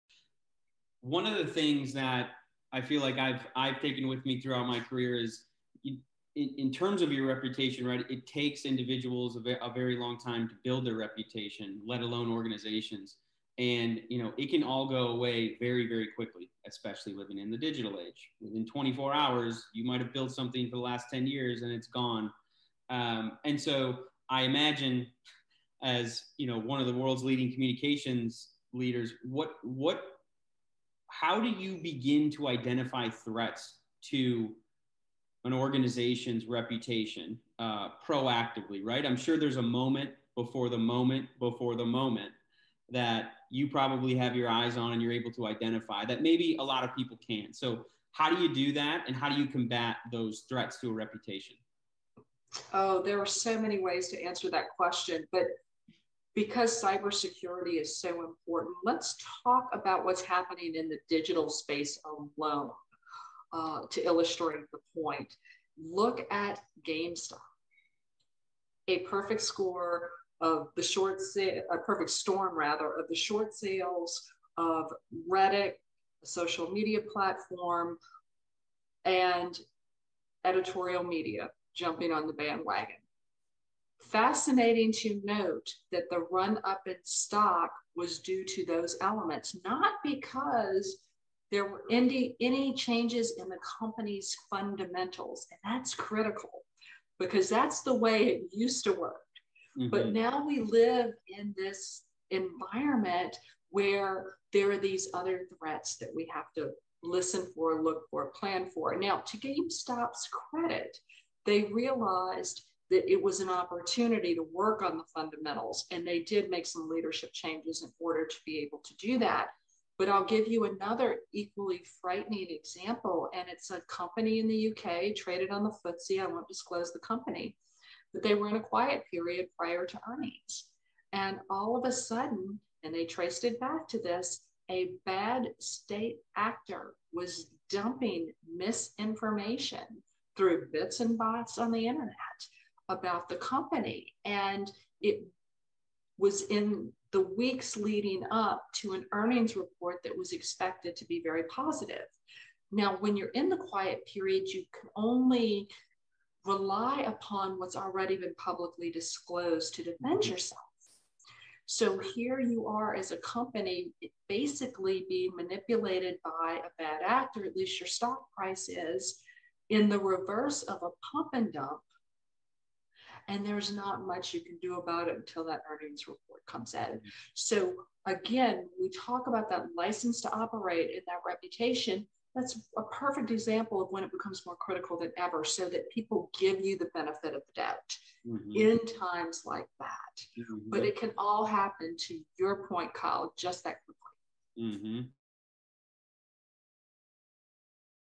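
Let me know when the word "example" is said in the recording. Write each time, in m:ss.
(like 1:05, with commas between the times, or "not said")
2:02, 3:03.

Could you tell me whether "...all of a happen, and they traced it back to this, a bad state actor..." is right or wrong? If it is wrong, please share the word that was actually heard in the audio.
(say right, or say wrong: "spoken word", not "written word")
wrong: "sudden", not "happen".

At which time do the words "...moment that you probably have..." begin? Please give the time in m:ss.
0:41.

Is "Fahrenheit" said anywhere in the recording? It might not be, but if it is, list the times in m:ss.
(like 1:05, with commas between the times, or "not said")
not said.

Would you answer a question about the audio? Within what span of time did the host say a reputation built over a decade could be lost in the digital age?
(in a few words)
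24 hours.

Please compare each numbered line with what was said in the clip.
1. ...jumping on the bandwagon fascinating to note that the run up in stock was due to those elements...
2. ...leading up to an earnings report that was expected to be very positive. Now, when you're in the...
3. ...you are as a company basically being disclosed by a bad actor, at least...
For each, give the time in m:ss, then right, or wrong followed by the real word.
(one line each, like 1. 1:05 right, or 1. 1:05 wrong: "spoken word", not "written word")
1. 1:21 right
2. 2:27 right
3. 2:42 wrong: "manipulated", not "disclosed".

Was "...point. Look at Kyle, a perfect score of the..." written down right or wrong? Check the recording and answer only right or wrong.
wrong.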